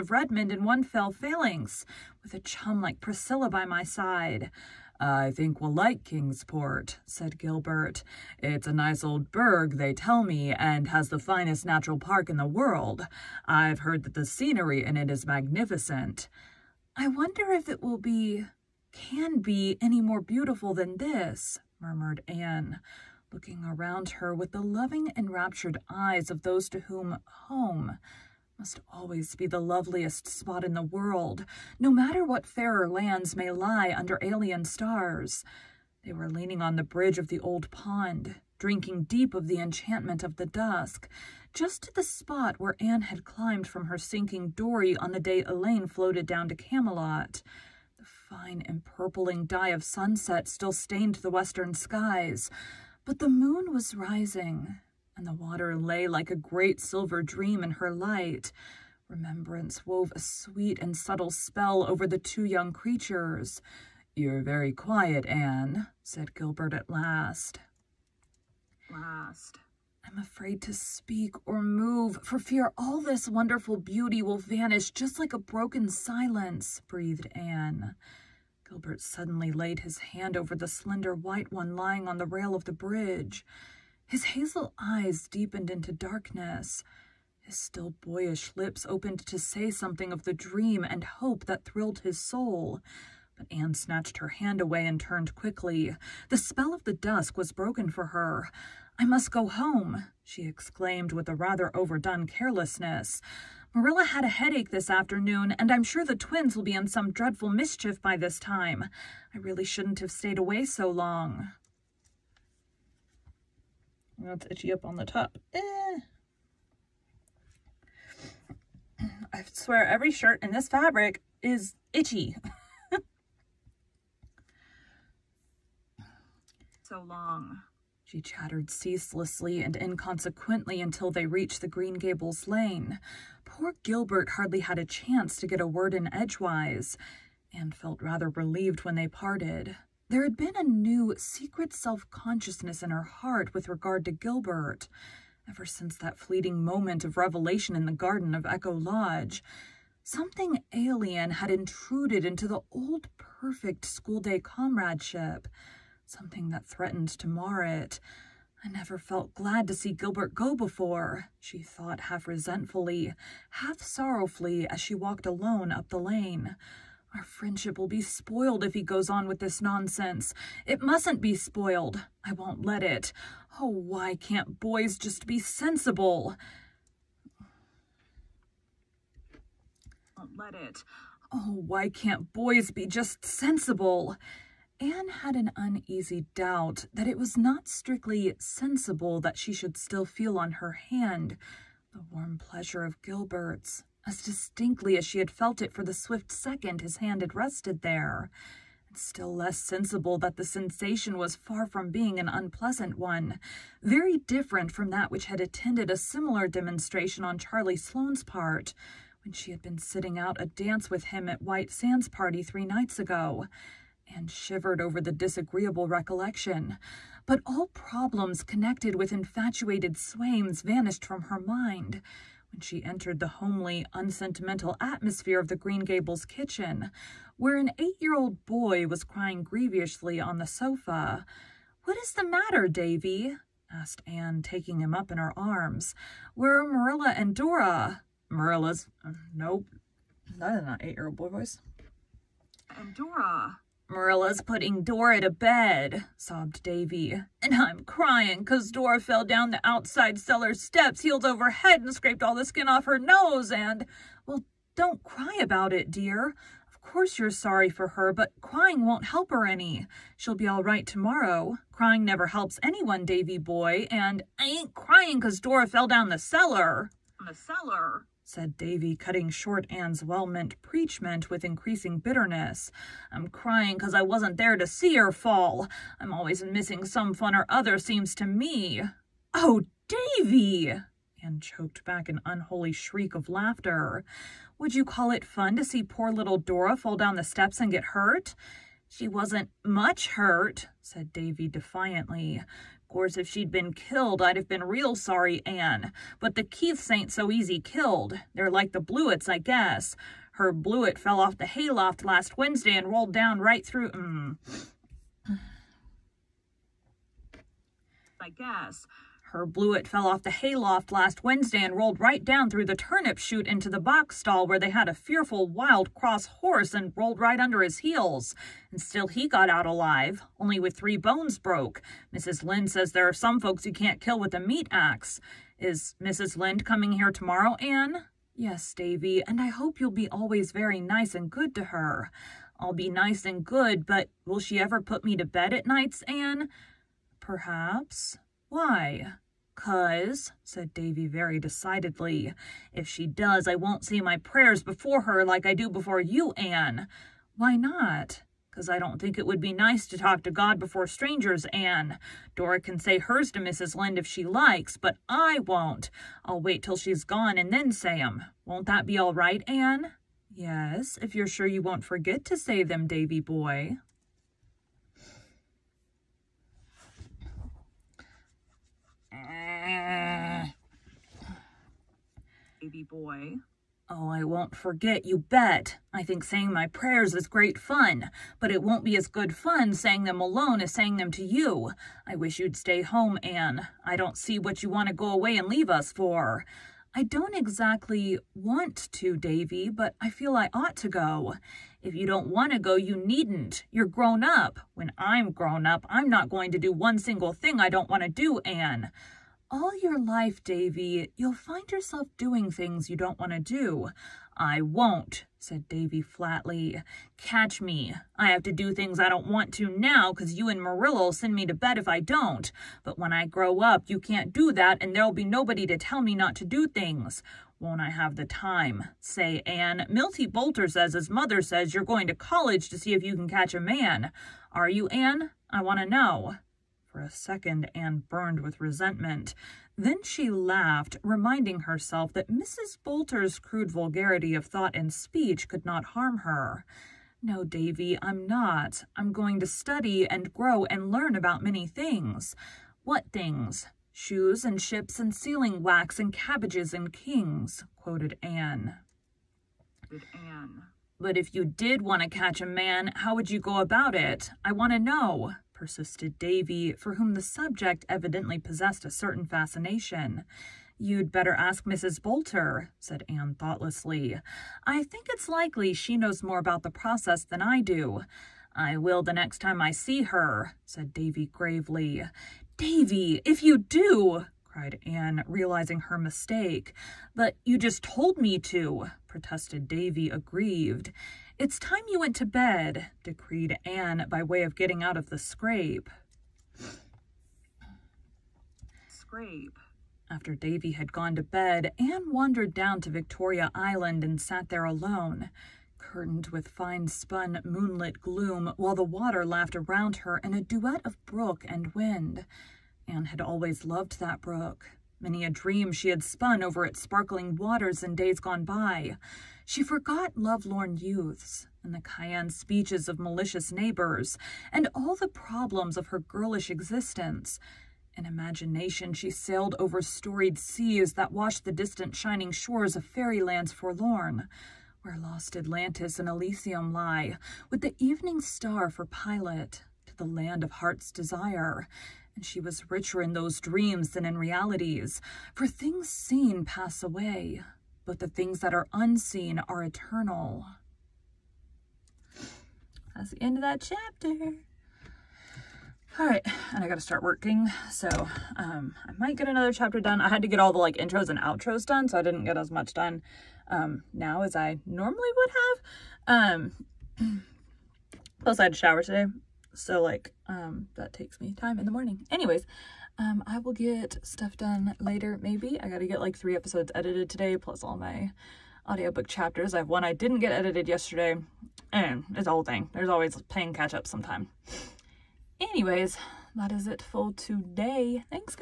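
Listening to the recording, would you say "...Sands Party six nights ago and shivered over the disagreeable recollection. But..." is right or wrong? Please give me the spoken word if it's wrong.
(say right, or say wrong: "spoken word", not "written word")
wrong: "three", not "six".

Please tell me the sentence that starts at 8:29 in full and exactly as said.
She forgot lovelorn youths, and the cayenne speeches of malicious neighbors, and all the problems of her girlish existence.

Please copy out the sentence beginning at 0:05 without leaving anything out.
I think we'll like Kingsport, said Gilbert.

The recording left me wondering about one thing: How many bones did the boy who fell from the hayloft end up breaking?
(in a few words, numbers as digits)
3.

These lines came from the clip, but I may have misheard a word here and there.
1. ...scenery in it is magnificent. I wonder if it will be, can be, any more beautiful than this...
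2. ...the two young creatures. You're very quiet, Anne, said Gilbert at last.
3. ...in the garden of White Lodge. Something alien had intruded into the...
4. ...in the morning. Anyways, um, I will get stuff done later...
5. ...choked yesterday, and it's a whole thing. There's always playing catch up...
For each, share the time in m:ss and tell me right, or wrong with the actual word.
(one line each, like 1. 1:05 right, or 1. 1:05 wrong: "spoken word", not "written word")
1. 0:14 right
2. 1:02 right
3. 2:27 wrong: "Echo", not "White"
4. 9:21 right
5. 9:30 wrong: "edited", not "choked".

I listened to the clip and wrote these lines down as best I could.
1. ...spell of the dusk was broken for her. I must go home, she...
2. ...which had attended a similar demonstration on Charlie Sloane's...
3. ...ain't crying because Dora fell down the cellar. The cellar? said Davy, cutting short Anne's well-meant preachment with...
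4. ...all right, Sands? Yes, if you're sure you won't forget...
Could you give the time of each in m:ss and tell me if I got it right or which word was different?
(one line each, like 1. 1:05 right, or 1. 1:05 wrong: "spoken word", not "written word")
1. 1:36 right
2. 3:25 right
3. 4:24 right
4. 5:58 wrong: "Anne", not "Sands".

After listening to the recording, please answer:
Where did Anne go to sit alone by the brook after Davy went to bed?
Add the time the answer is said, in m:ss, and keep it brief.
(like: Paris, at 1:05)
Victoria Island, at 8:12.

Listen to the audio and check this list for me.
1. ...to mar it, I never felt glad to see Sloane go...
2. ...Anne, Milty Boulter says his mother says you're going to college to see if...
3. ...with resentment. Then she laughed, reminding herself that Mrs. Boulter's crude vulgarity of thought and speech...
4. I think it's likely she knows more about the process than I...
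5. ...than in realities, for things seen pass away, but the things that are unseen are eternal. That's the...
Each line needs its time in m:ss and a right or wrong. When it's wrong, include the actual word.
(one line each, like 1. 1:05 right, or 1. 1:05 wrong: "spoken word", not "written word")
1. 2:37 wrong: "Gilbert", not "Sloane"
2. 6:59 right
3. 7:08 right
4. 7:44 right
5. 8:53 right.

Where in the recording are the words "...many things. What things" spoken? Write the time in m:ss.
7:21.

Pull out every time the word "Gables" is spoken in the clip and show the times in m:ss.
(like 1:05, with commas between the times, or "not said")
2:11, 3:45.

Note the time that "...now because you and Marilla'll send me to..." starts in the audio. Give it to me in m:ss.
6:49.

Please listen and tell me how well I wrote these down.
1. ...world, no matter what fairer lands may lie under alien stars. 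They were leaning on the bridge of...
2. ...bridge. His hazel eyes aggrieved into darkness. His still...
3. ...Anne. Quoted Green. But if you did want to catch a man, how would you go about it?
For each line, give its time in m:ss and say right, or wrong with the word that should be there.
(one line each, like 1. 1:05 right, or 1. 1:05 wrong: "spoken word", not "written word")
1. 0:30 right
2. 1:22 wrong: "deepened", not "aggrieved"
3. 7:28 wrong: "Anne", not "Green".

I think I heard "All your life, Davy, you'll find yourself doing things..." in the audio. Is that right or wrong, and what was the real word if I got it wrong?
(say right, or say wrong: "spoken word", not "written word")
right.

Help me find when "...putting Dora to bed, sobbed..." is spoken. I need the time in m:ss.
4:04.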